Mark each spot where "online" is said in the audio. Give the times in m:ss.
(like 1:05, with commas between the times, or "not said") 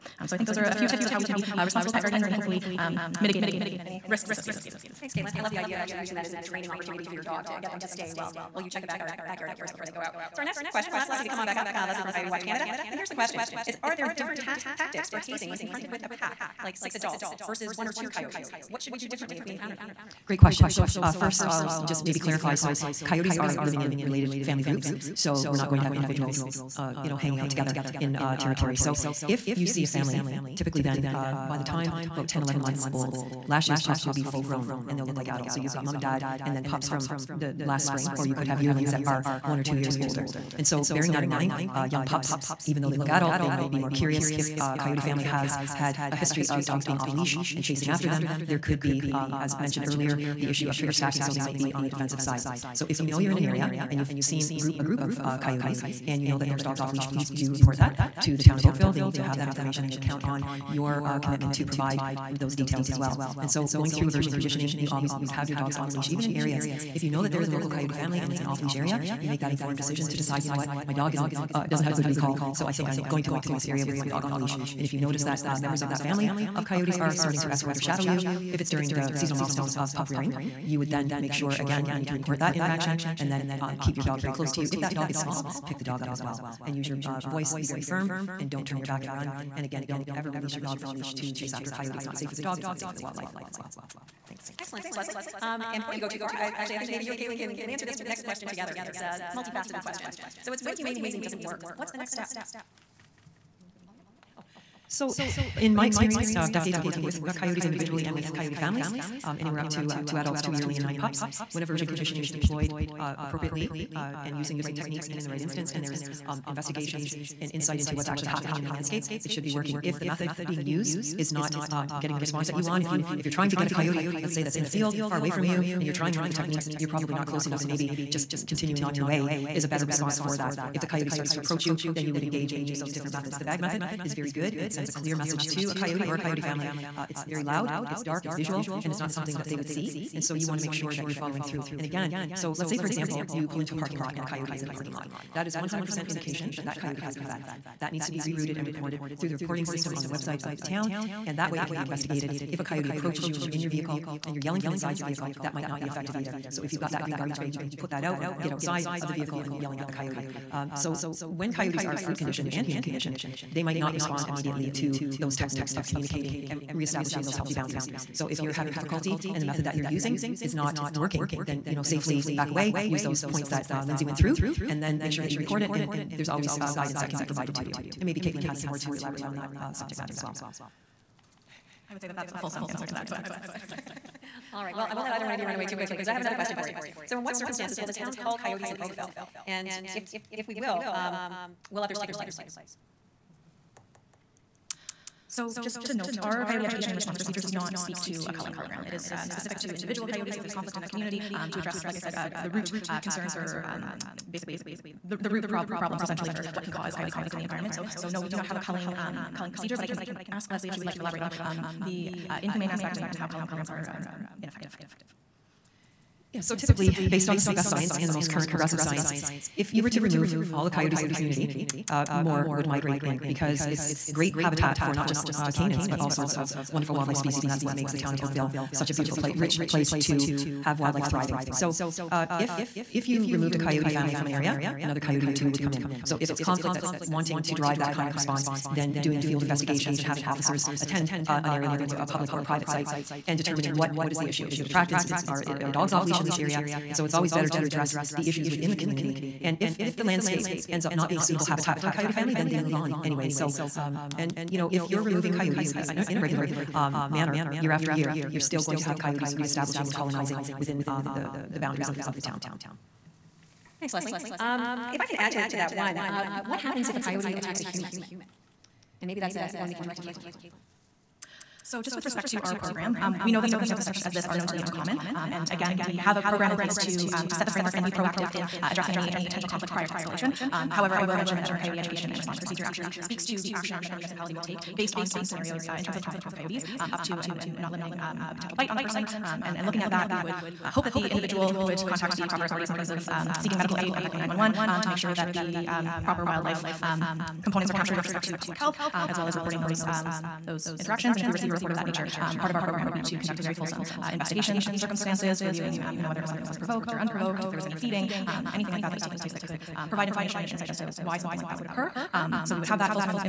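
not said.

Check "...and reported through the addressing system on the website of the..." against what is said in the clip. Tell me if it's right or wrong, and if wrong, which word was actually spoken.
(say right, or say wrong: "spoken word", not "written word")
wrong: "reporting", not "addressing".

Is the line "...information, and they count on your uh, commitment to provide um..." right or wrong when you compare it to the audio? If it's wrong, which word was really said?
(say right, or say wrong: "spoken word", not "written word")
right.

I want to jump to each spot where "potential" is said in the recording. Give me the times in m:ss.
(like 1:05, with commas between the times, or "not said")
4:39, 4:48.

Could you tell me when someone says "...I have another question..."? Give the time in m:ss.
3:06.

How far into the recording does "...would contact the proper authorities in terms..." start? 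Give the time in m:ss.
4:51.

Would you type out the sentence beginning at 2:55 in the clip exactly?
And there's always uh, guidance that can be provided to you.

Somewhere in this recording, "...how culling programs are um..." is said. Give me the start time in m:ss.
3:33.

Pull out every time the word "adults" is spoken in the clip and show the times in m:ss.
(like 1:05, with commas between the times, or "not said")
0:16, 0:35, 0:43, 1:50.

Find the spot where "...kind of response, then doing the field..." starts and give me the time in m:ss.
3:57.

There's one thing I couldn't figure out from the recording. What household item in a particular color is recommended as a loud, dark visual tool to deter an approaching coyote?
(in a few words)
green garbage bag.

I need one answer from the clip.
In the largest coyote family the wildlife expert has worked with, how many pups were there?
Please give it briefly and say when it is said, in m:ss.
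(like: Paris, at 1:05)
9, at 1:50.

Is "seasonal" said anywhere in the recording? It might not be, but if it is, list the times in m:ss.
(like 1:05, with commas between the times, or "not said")
1:19.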